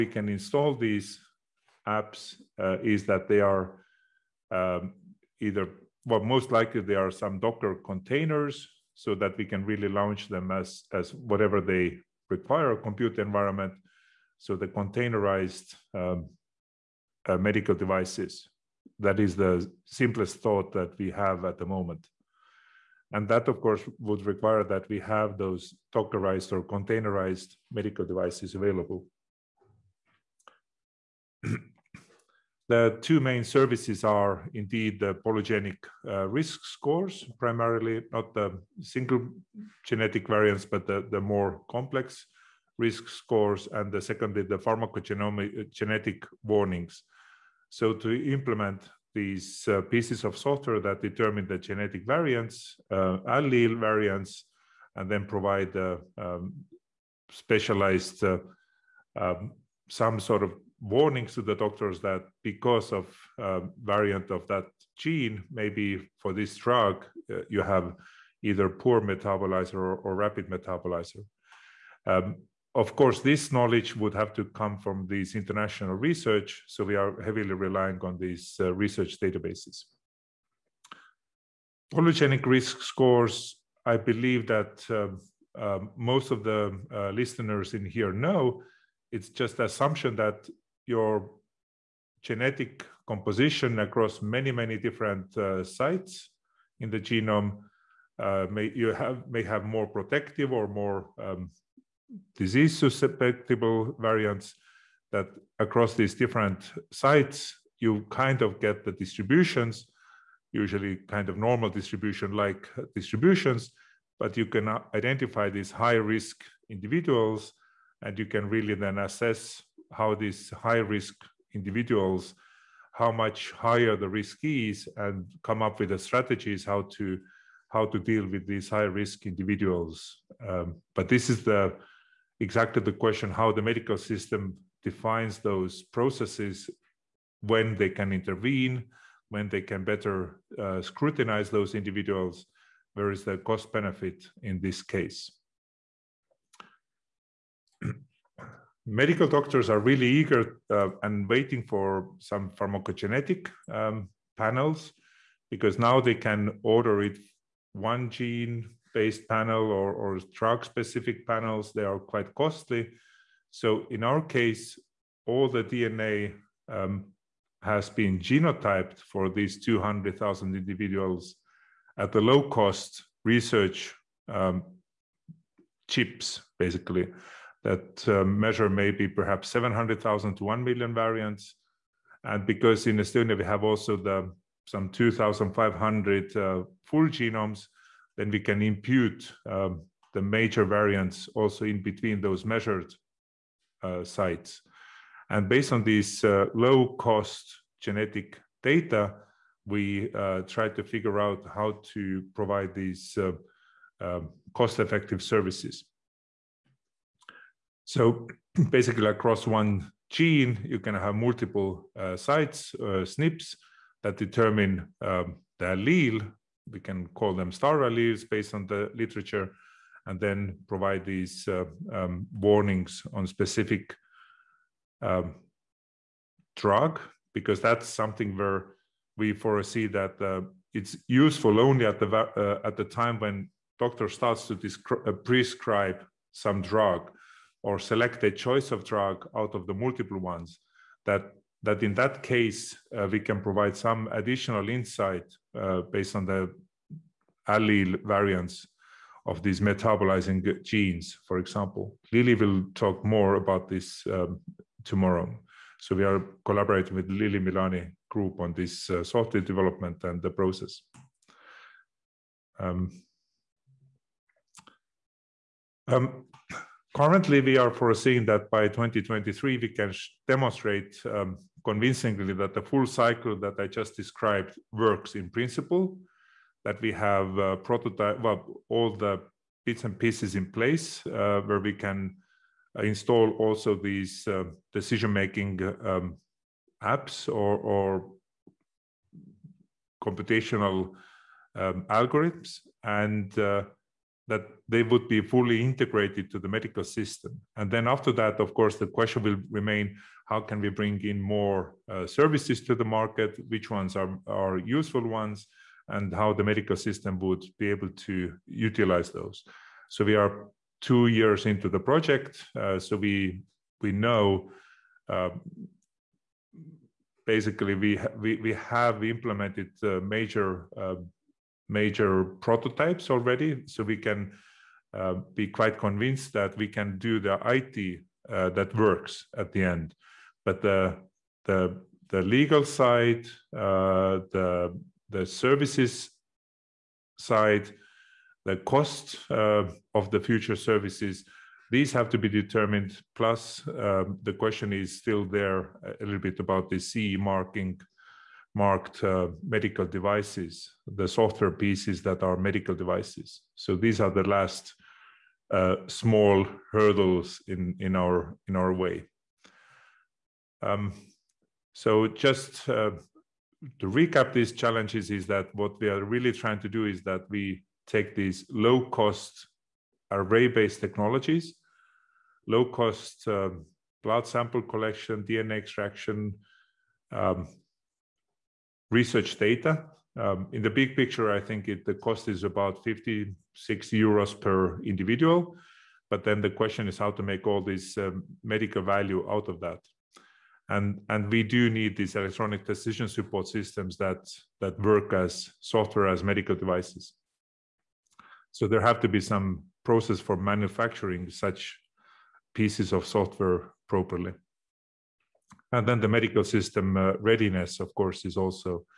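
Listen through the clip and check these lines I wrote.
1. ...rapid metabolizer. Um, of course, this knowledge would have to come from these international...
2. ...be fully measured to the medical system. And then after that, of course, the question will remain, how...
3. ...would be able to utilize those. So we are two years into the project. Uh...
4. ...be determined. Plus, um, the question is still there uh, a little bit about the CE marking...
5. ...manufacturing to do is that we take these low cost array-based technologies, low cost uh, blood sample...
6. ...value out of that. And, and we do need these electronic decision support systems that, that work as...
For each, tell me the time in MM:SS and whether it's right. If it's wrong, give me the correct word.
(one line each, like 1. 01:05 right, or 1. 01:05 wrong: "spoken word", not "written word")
1. 01:10 right
2. 04:55 wrong: "integrated", not "measured"
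3. 05:07 right
4. 05:42 right
5. 06:06 wrong: "trying", not "manufacturing"
6. 06:28 right.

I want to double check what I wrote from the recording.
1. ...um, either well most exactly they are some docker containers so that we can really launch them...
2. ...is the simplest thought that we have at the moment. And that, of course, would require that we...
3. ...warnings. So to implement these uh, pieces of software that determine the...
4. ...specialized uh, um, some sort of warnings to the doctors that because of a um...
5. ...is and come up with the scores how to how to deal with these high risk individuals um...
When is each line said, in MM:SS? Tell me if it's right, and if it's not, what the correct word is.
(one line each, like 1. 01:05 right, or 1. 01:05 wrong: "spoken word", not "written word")
1. 00:04 wrong: "likely", not "exactly"
2. 00:19 right
3. 00:46 right
4. 00:57 right
5. 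02:04 wrong: "strategies", not "scores".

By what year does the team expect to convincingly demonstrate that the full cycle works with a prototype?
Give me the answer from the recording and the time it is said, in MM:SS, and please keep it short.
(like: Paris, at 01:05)
2023, at 04:28.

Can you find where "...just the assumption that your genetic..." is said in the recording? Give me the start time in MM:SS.
01:29.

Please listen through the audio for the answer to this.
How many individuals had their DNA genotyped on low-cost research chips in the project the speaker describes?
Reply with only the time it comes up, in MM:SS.
02:49.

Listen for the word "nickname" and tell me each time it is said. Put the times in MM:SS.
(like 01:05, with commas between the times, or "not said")
not said.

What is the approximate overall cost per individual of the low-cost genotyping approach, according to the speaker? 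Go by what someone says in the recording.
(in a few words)
56 euros.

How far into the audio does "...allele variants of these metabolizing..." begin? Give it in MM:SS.
04:07.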